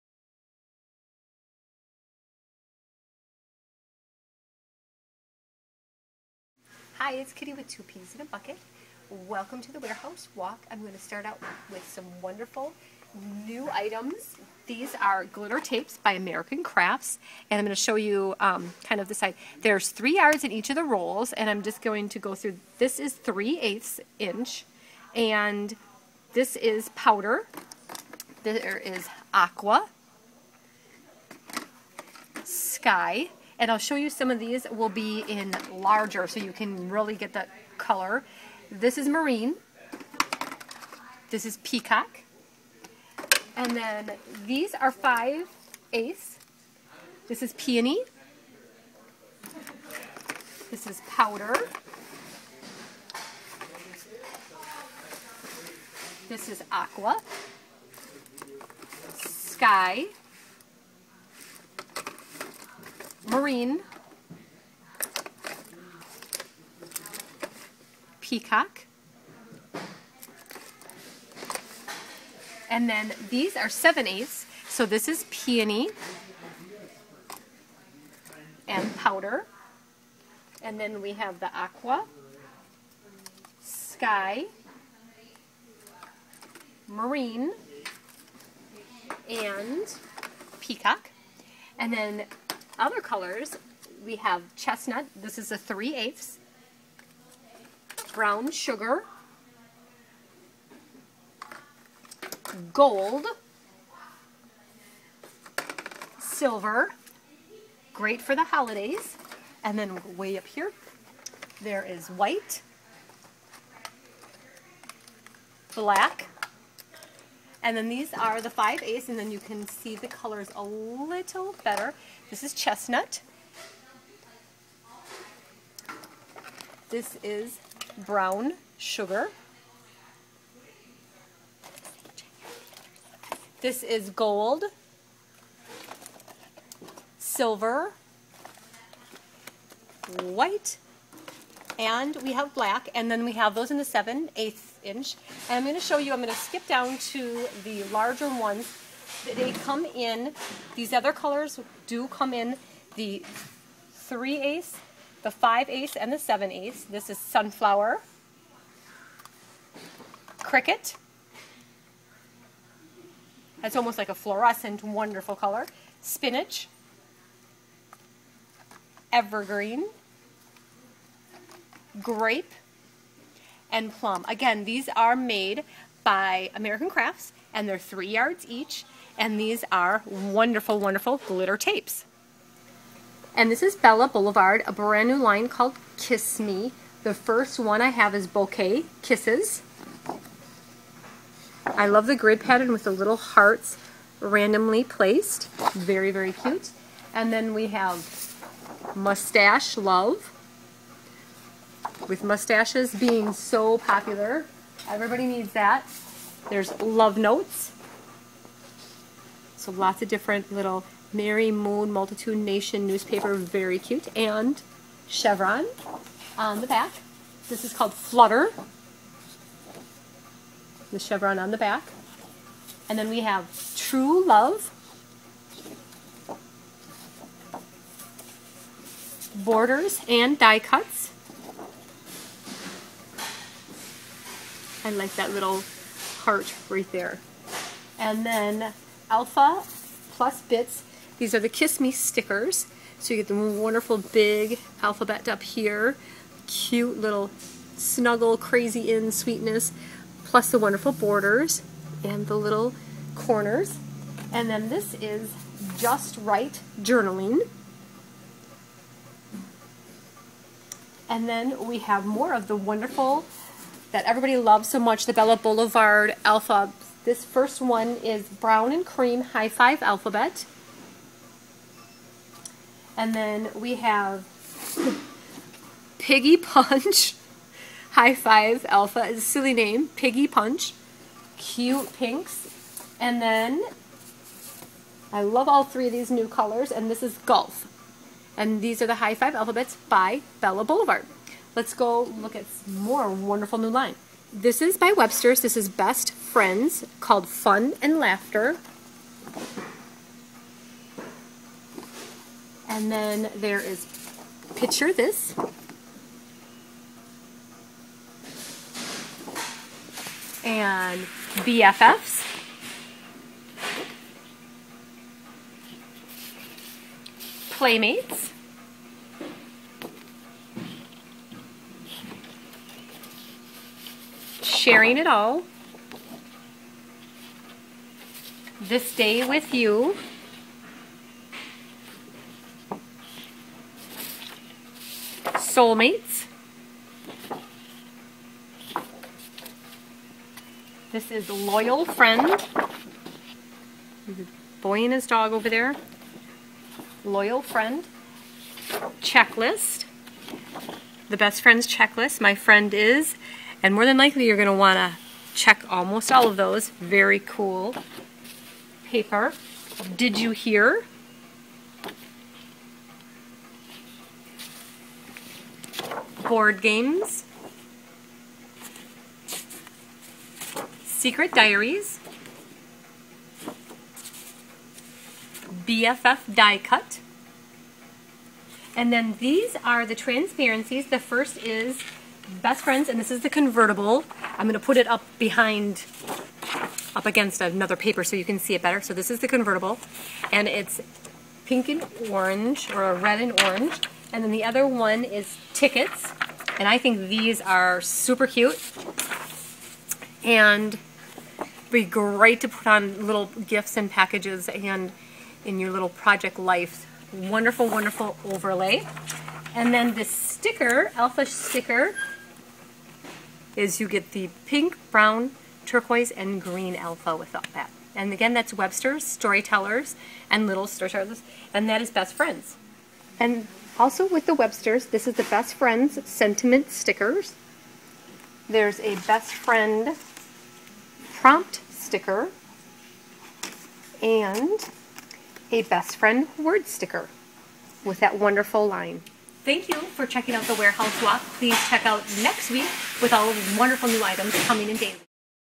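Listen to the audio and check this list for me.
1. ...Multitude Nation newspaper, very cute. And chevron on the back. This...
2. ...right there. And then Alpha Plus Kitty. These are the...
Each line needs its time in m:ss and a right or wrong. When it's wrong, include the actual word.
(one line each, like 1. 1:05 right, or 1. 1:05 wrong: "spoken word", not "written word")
1. 3:31 right
2. 3:56 wrong: "Bits", not "Kitty".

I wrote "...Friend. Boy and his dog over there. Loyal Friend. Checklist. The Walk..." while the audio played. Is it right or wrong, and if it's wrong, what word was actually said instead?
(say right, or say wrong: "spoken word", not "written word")
wrong: "Best", not "Walk".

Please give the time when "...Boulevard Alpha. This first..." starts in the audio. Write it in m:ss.
4:25.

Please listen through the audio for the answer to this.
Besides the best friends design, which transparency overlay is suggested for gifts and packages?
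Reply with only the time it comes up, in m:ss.
6:35.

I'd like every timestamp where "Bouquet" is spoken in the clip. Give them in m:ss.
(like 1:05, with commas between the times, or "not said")
3:08.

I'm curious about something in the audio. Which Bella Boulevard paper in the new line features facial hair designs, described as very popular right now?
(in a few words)
Mustache Love.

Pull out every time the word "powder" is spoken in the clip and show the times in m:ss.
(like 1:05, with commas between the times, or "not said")
0:26, 0:51, 1:18.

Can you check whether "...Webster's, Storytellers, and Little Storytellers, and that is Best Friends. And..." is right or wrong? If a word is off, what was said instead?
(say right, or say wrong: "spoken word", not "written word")
right.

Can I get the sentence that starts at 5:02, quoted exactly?
And then there is Picture This.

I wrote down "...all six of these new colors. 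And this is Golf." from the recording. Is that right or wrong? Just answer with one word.
wrong.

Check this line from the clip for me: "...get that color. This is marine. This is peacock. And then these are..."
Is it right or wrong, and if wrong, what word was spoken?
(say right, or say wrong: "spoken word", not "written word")
right.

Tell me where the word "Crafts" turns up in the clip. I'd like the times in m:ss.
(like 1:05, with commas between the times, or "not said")
0:16, 2:56.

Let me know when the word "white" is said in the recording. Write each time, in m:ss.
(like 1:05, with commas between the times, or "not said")
1:52, 2:20.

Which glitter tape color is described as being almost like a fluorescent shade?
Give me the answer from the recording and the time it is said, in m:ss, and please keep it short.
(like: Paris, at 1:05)
Cricket, at 2:40.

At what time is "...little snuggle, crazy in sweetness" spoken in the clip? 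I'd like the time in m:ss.
4:06.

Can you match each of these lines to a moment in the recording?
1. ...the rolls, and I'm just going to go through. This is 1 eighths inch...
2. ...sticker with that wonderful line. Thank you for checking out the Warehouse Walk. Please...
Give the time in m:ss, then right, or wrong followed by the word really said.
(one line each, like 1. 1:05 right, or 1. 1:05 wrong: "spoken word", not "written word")
1. 0:20 wrong: "3", not "1"
2. 7:16 right.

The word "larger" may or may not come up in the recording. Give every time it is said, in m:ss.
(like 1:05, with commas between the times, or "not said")
0:35, 2:27.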